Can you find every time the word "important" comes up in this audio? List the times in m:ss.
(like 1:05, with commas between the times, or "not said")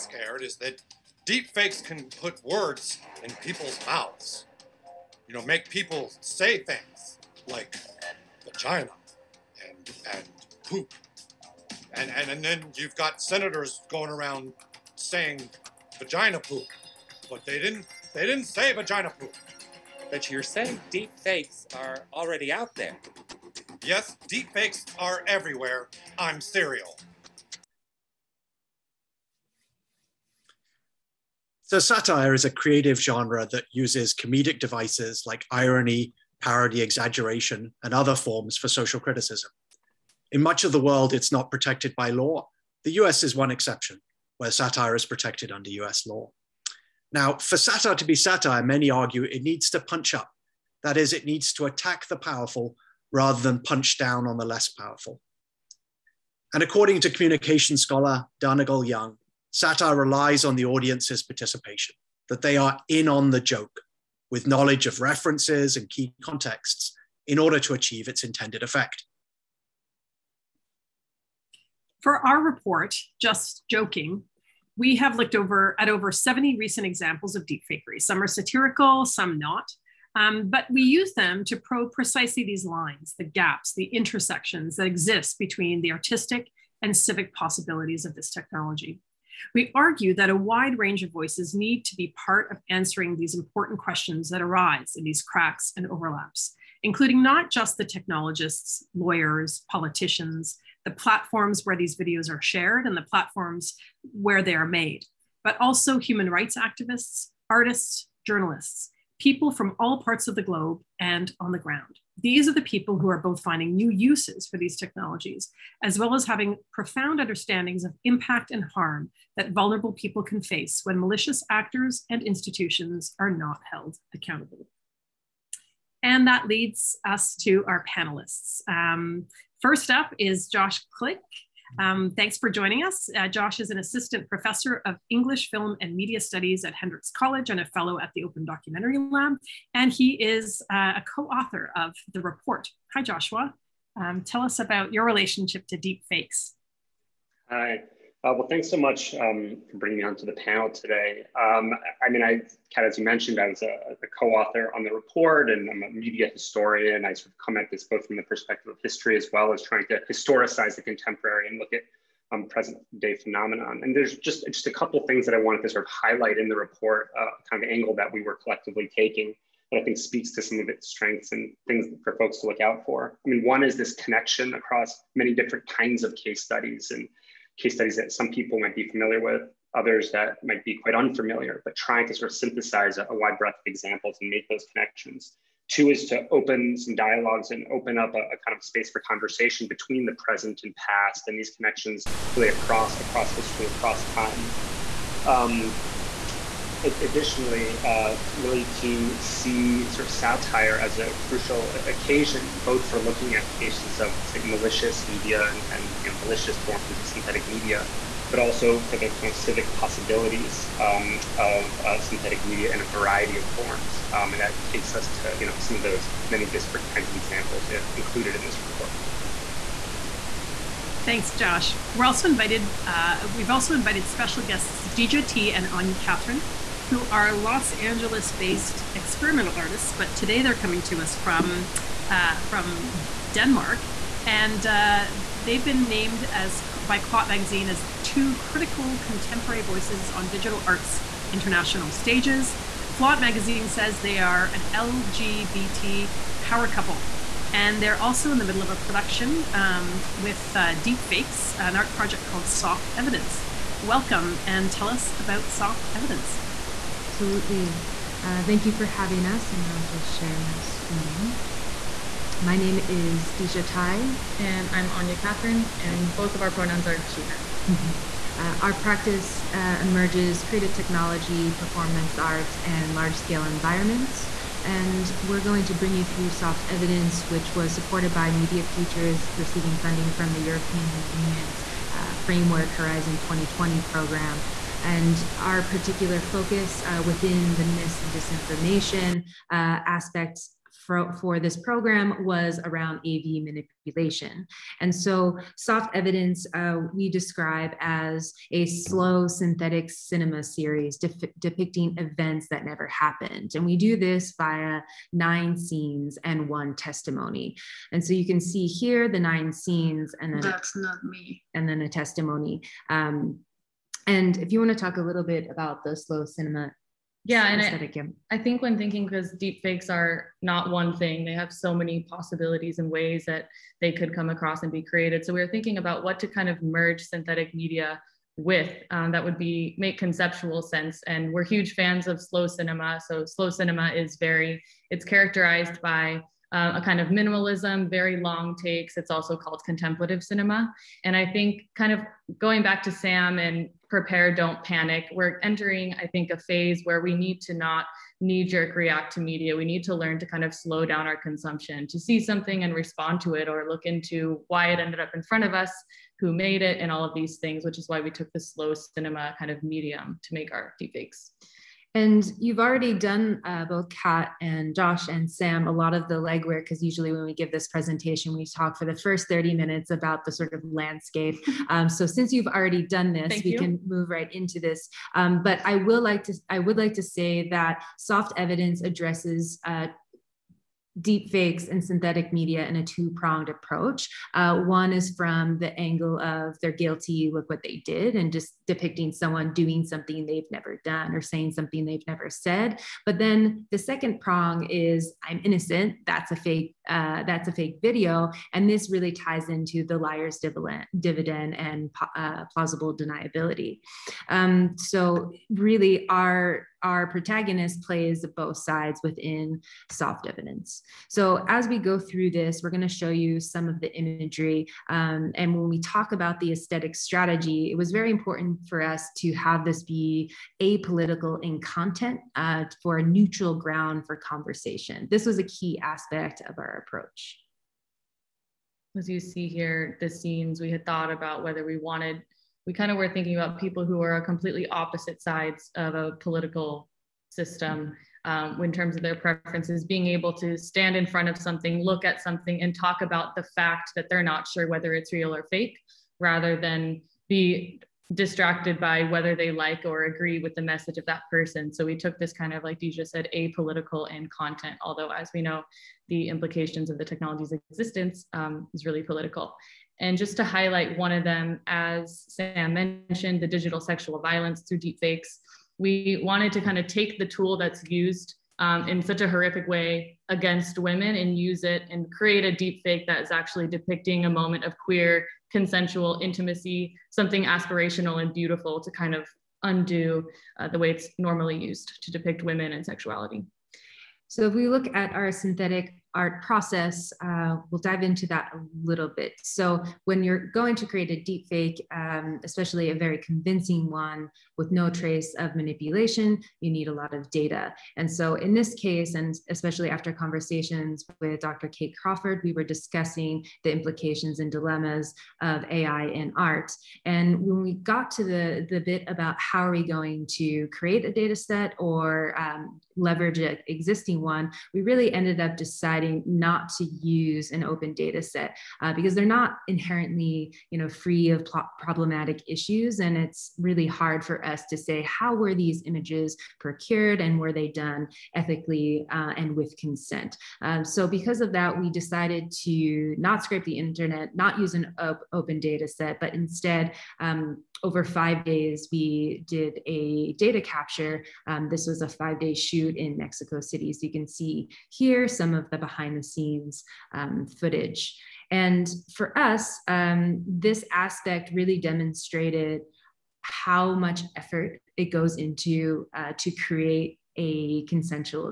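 1:33, 6:58.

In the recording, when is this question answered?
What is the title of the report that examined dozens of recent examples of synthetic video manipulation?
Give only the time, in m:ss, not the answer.
1:13.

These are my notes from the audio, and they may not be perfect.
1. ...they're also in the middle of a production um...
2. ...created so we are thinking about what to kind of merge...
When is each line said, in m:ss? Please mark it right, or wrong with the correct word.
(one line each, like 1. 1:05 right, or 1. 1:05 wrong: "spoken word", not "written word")
1. 4:07 right
2. 5:24 right.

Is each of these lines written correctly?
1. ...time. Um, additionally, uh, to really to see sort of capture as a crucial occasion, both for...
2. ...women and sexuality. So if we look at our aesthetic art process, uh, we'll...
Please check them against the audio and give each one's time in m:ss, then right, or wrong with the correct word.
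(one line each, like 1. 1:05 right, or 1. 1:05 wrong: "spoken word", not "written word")
1. 3:14 wrong: "satire", not "capture"
2. 8:02 wrong: "synthetic", not "aesthetic".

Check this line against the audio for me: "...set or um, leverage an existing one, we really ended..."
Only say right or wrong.
right.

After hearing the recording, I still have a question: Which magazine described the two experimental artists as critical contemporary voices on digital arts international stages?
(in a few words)
Clot Magazine.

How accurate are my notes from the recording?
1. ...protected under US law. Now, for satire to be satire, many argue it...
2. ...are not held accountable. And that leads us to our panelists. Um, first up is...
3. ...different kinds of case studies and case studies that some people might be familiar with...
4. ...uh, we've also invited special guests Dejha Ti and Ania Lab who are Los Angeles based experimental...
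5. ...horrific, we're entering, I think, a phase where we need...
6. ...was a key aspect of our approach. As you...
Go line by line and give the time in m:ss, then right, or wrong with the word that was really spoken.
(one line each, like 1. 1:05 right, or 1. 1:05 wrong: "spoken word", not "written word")
1. 0:45 right
2. 2:03 right
3. 2:55 right
4. 3:42 wrong: "Catherine", not "Lab"
5. 5:44 wrong: "panic", not "horrific"
6. 7:05 right.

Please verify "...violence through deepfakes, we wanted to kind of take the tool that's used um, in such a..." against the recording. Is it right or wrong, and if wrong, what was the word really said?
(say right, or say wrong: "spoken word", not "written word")
right.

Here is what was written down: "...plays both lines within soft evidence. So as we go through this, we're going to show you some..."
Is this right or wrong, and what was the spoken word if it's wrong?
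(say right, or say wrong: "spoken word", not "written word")
wrong: "sides", not "lines".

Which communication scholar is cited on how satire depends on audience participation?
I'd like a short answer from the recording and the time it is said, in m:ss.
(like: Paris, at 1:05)
Dannagal Young, at 0:58.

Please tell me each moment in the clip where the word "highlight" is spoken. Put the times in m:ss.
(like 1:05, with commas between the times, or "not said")
2:45, 7:40.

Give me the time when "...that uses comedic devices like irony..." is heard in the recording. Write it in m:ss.
0:33.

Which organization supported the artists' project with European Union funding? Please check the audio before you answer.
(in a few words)
Media Futures.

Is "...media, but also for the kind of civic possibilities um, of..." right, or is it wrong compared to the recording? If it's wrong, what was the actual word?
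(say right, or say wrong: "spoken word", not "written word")
right.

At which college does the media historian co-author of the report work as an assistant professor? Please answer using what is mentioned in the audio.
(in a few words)
Hendrix College.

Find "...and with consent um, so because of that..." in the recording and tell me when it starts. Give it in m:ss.
8:49.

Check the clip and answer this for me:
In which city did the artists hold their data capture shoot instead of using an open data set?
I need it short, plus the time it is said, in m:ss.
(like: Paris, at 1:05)
Mexico City, at 9:03.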